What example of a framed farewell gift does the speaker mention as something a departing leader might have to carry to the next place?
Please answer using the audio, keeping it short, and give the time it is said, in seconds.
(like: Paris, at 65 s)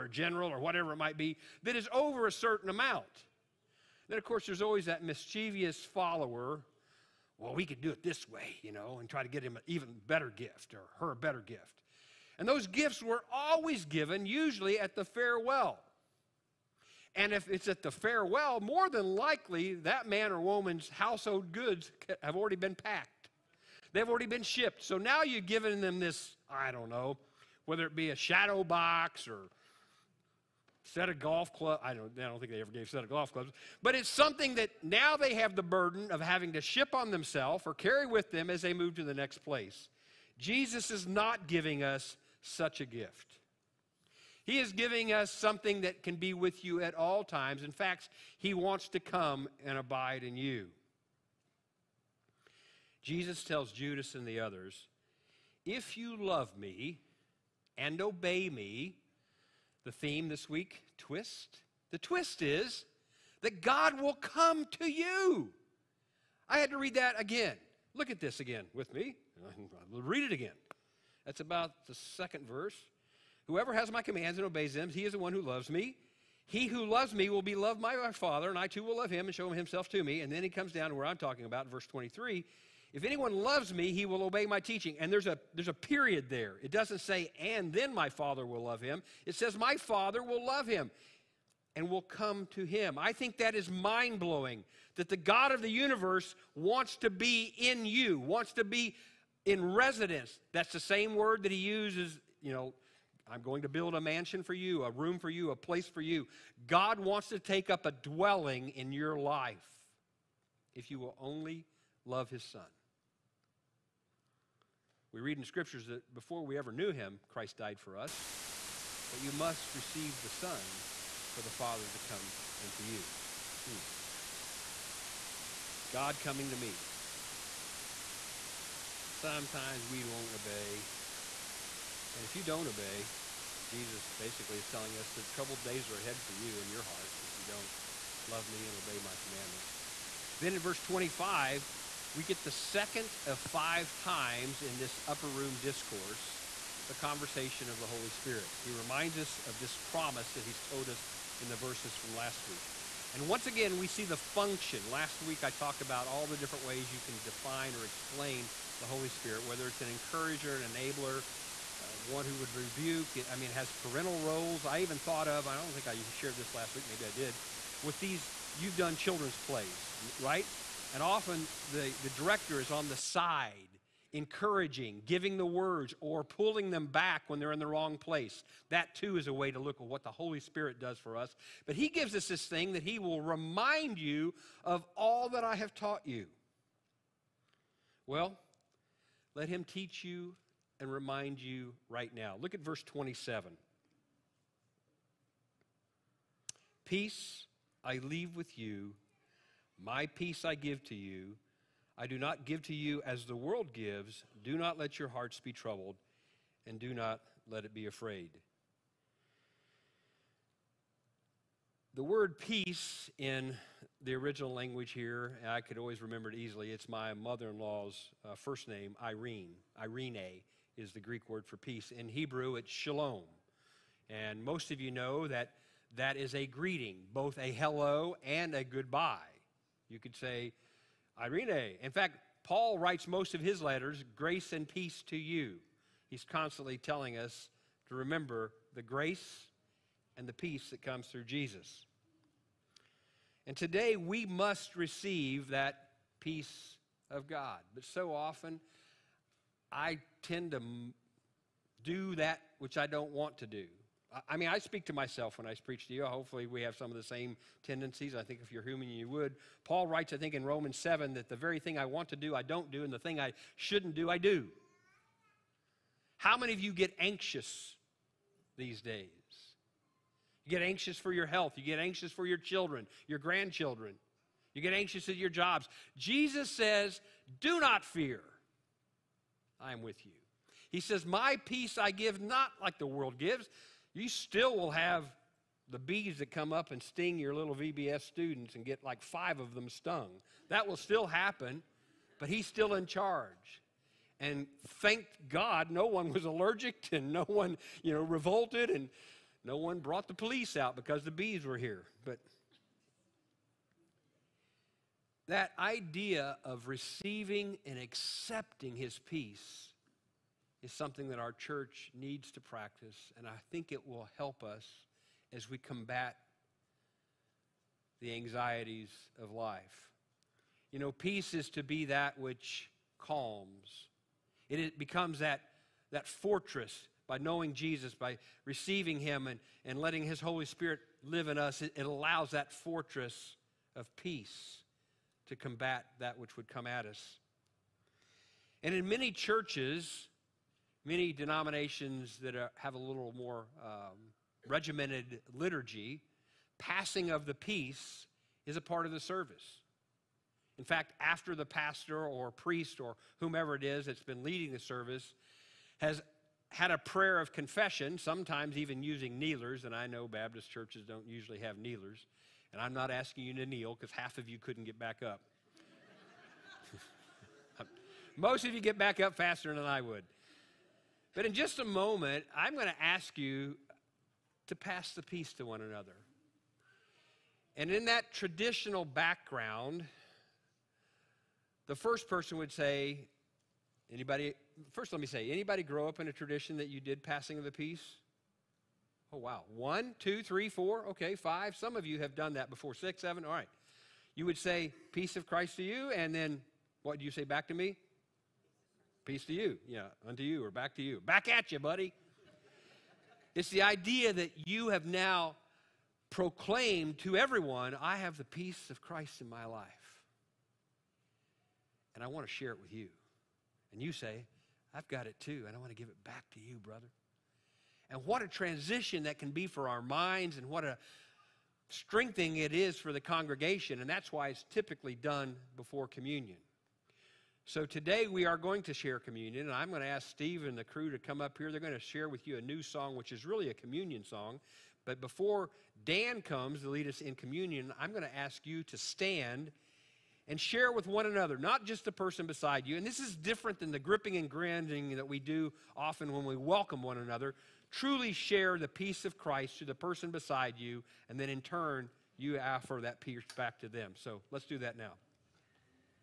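shadow box, at 28 s.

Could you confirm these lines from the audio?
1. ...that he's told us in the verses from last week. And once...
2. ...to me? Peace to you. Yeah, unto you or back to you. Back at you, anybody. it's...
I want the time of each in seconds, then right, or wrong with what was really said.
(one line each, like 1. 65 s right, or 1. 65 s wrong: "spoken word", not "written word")
1. 150 s right
2. 397 s wrong: "buddy", not "anybody".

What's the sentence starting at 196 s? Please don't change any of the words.
Peace I leave with you my peace I give to you.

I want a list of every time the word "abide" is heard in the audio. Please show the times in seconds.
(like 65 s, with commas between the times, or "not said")
49 s.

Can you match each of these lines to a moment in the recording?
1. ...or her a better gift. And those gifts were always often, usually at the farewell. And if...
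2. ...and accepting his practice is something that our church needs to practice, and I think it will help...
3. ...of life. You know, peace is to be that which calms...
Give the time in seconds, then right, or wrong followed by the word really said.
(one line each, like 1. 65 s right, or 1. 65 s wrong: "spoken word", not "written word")
1. 10 s wrong: "given", not "often"
2. 307 s wrong: "peace", not "practice"
3. 319 s right.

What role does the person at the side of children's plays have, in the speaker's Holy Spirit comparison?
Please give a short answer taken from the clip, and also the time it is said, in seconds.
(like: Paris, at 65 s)
the director, at 171 s.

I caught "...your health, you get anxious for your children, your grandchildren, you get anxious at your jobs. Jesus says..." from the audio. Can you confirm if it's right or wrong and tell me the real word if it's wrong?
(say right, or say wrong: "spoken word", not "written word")
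right.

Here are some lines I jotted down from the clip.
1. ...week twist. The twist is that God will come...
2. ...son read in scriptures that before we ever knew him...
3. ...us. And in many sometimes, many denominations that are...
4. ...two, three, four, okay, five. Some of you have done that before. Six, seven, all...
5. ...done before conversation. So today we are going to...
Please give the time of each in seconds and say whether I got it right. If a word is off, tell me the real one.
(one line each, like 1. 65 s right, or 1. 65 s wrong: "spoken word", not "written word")
1. 60 s right
2. 112 s right
3. 336 s wrong: "churches", not "sometimes"
4. 389 s right
5. 424 s wrong: "communion", not "conversation".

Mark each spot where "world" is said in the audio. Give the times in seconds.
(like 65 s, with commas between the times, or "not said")
203 s, 282 s.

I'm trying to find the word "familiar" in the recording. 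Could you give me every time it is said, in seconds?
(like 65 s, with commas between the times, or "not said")
not said.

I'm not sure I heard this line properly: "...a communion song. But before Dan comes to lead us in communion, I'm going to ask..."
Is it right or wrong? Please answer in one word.
right.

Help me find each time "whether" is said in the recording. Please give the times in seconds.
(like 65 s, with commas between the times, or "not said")
27 s, 159 s.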